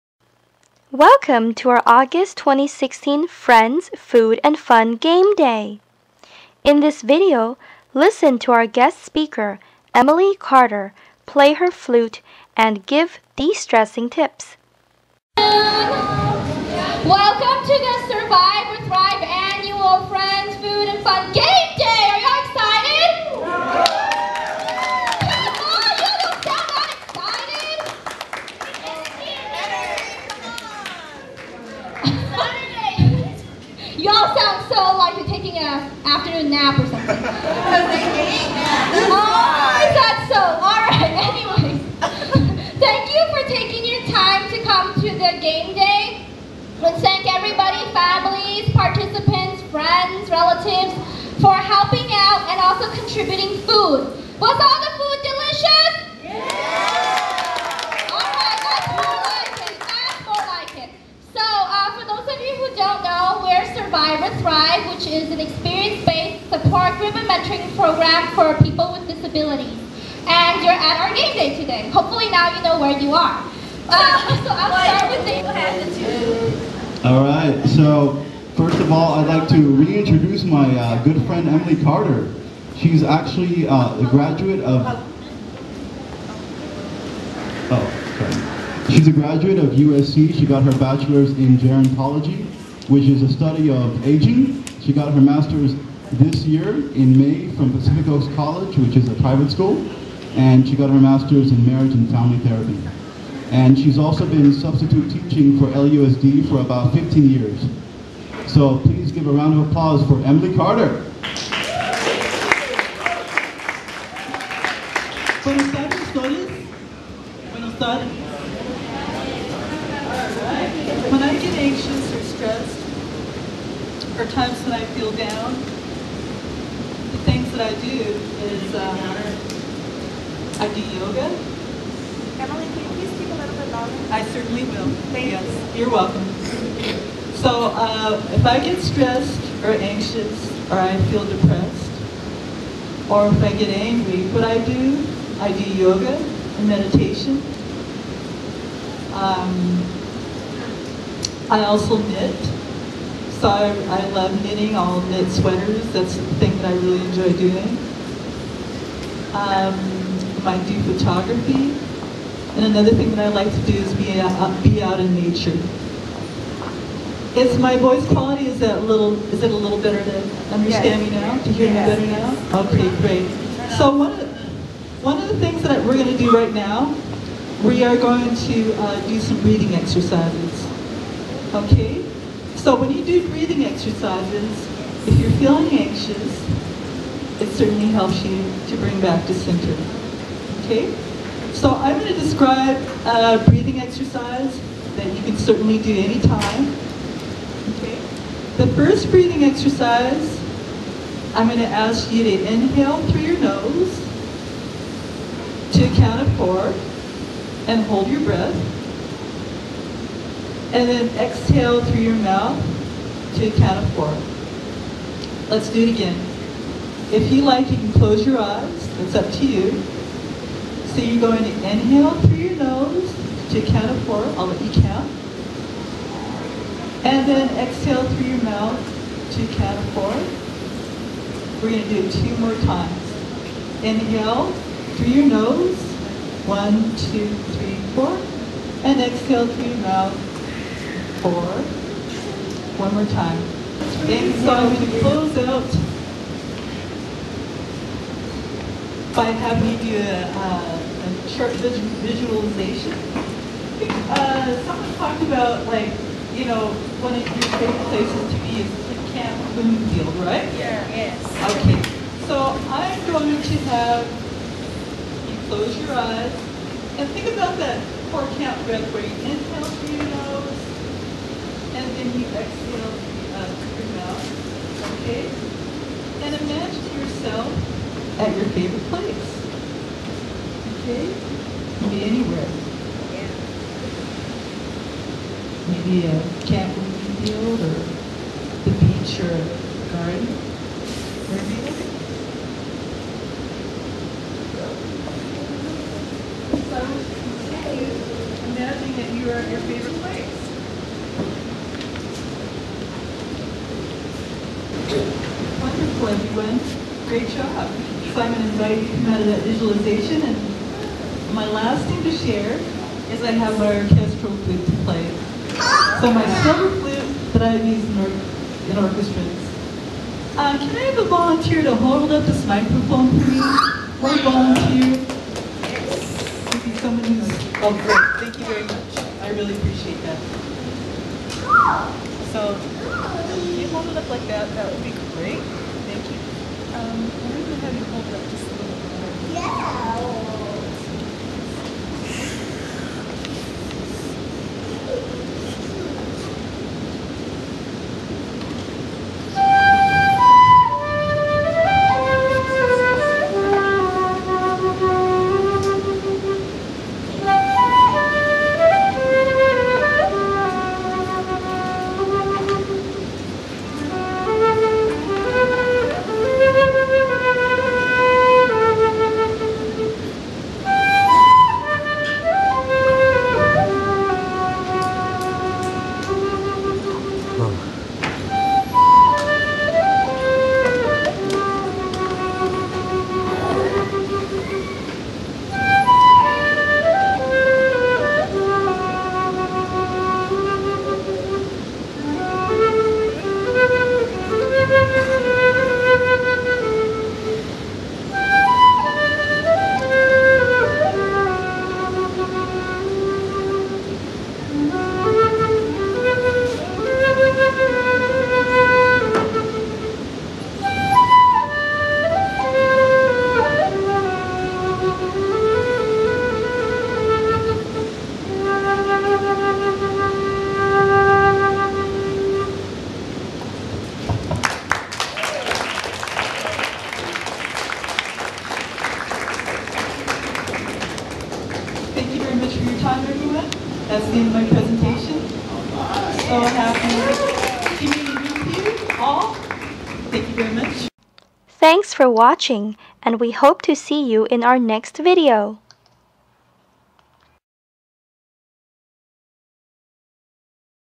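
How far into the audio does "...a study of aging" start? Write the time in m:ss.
1:33.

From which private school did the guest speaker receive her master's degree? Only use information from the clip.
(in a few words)
Pacific Coast College.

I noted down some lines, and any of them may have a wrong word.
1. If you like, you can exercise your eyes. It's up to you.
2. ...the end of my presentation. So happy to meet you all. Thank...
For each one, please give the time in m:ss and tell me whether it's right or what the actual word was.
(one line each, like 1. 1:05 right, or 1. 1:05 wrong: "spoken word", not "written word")
1. 3:37 wrong: "close", not "exercise"
2. 7:14 right.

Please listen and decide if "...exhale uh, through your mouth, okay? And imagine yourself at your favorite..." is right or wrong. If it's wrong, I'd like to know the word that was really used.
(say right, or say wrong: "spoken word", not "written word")
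right.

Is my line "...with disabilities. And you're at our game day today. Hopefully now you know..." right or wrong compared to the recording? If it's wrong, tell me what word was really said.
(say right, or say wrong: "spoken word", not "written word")
right.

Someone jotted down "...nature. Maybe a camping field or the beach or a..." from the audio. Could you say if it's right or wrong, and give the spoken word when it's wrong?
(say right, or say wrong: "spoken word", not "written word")
wrong: "anywhere", not "nature".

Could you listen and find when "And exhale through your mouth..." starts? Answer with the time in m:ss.
3:58.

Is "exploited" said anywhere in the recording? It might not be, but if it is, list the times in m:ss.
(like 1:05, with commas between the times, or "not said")
not said.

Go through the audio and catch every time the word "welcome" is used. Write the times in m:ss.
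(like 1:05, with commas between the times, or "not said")
0:00, 0:15, 2:15.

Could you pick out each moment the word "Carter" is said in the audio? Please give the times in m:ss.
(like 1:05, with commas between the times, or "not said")
0:10, 1:21, 1:50.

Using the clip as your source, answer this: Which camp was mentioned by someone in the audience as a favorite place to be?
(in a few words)
Camp Bloomfield.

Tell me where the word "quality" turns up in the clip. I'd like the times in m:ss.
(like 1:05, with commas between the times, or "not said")
2:48.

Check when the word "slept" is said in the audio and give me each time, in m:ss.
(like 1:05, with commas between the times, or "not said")
not said.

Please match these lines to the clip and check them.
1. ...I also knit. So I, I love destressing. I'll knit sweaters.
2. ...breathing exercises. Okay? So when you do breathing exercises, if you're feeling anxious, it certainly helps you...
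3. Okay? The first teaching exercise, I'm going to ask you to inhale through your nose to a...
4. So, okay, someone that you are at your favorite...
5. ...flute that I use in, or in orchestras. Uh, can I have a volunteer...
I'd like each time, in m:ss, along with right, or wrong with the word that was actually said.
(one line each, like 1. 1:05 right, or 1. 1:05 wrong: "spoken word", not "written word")
1. 2:31 wrong: "knitting", not "destressing"
2. 2:59 right
3. 3:17 wrong: "breathing", not "teaching"
4. 4:57 wrong: "imagine", not "someone"
5. 5:16 right.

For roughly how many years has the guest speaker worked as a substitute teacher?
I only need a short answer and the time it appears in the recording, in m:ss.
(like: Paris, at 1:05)
15, at 1:46.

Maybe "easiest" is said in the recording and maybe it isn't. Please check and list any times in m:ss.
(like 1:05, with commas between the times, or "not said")
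not said.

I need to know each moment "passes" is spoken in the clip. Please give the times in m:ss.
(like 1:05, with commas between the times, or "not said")
not said.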